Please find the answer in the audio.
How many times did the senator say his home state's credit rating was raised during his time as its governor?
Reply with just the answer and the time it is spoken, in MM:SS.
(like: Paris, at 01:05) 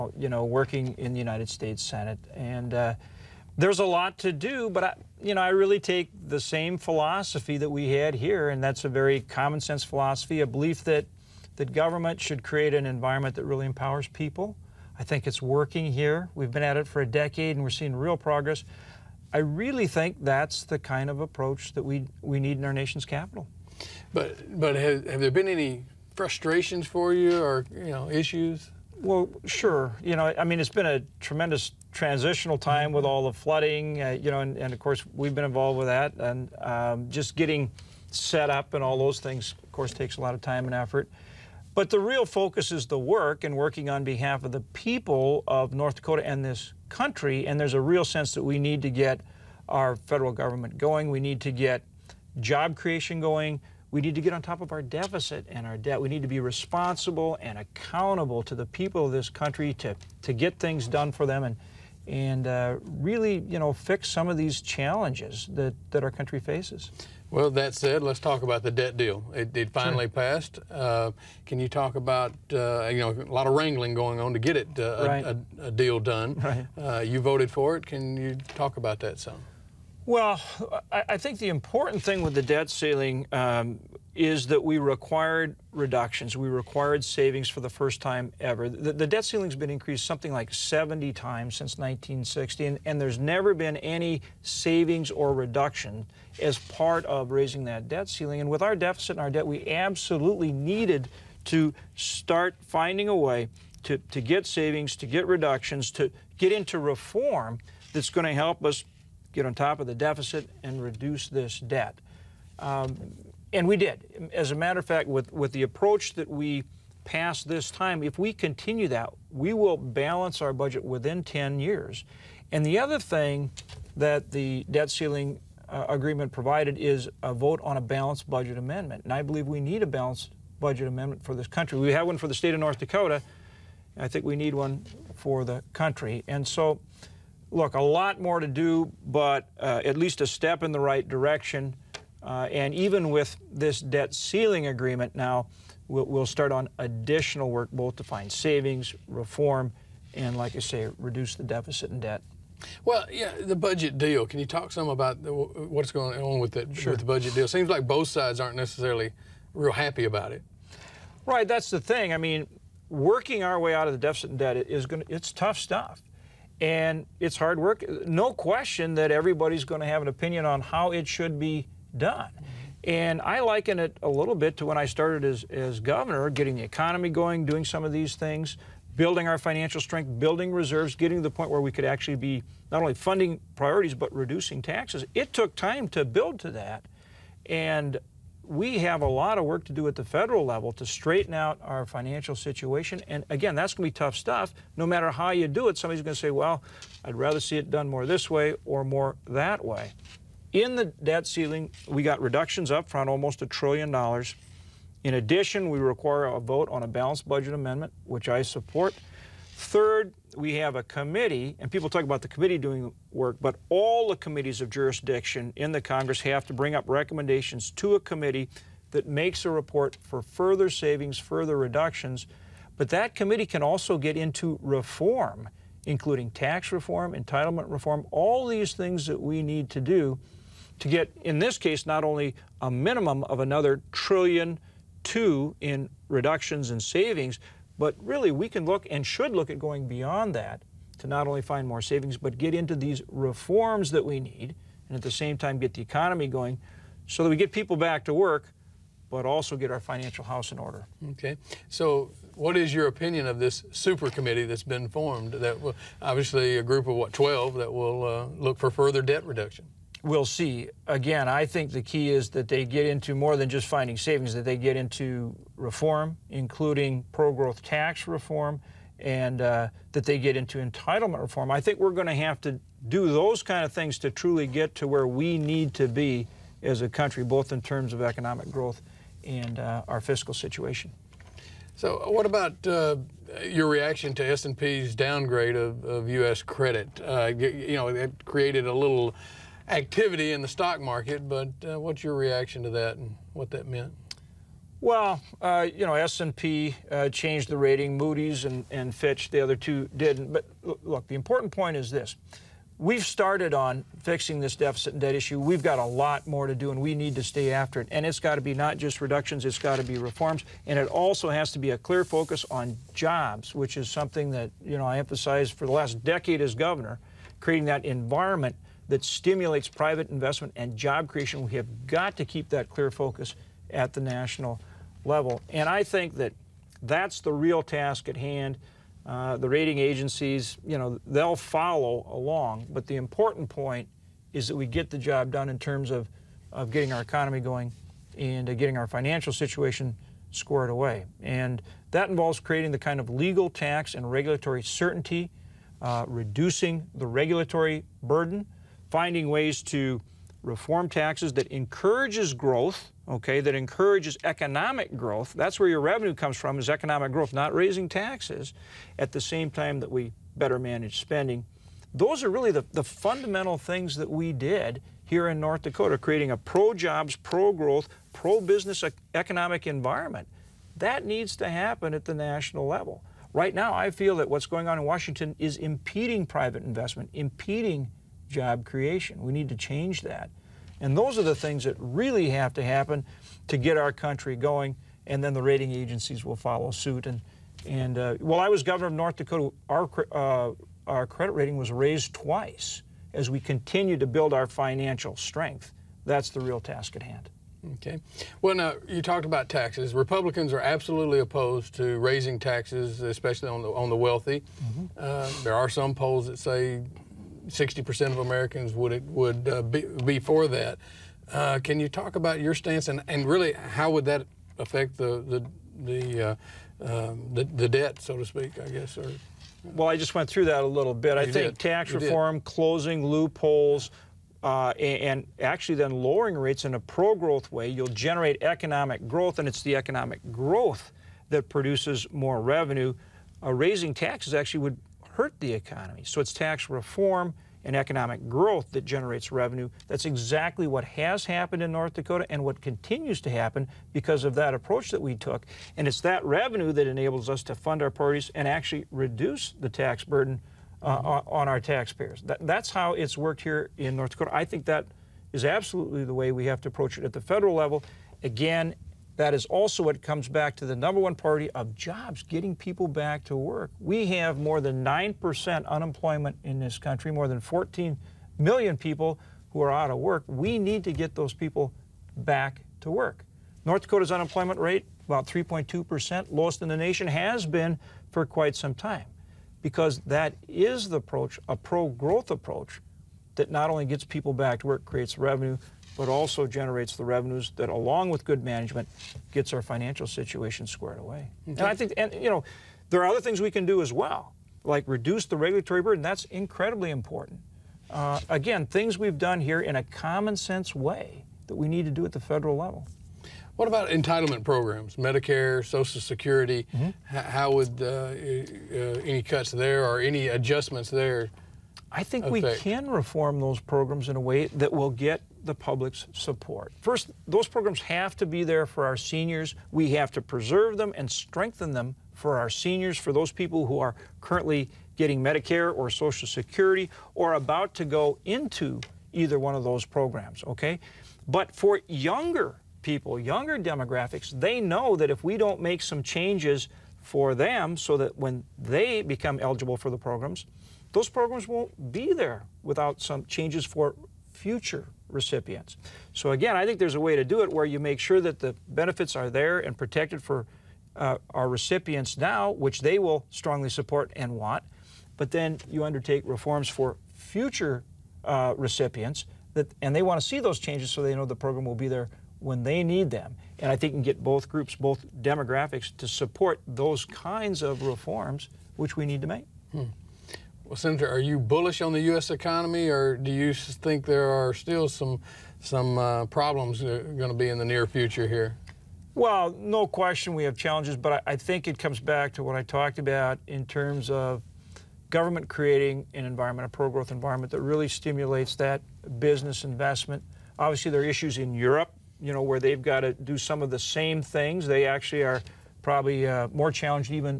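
twice, at 06:32.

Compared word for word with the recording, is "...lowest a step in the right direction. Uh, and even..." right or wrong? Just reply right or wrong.
wrong.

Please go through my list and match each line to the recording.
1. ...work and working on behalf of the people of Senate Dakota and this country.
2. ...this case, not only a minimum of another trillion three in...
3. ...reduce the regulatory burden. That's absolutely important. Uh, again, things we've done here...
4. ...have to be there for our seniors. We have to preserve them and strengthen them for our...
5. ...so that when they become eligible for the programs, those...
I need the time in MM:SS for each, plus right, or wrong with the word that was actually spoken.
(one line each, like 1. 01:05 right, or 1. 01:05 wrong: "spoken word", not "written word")
1. 00:42 wrong: "North", not "Senate"
2. 03:51 wrong: "two", not "three"
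3. 08:14 wrong: "incredibly", not "absolutely"
4. 08:37 right
5. 08:57 right.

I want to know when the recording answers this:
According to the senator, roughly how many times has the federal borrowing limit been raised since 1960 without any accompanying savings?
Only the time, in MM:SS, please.
01:30.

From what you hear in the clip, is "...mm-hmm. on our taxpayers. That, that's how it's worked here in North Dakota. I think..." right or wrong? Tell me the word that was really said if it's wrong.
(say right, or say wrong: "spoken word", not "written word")
right.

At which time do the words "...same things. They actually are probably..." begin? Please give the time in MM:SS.
09:53.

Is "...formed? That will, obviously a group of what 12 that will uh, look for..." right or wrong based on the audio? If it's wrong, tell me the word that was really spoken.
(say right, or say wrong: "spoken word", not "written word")
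right.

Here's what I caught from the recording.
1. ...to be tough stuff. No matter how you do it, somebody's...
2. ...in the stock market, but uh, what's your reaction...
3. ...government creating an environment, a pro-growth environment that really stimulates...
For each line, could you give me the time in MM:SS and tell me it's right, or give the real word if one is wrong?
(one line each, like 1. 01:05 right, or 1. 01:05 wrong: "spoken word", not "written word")
1. 03:13 right
2. 04:50 right
3. 09:45 right.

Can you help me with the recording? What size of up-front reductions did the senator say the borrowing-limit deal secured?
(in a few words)
almost a trillion dollars.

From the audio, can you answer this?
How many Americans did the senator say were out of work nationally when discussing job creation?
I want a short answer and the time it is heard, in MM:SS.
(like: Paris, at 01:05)
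more than 14 million, at 07:47.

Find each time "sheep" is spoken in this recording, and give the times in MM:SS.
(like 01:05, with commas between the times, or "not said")
not said.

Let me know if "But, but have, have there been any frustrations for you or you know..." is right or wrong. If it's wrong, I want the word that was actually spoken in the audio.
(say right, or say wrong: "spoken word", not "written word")
right.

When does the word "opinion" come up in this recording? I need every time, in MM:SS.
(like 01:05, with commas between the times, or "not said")
02:50, 04:12.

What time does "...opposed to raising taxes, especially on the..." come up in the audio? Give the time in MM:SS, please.
06:41.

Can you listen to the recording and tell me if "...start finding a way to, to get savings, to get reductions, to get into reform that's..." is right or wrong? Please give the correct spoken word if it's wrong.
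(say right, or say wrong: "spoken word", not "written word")
right.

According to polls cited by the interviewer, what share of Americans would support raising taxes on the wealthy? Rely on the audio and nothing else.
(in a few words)
60%.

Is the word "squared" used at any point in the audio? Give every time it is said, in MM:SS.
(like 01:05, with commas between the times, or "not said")
05:40, 08:10.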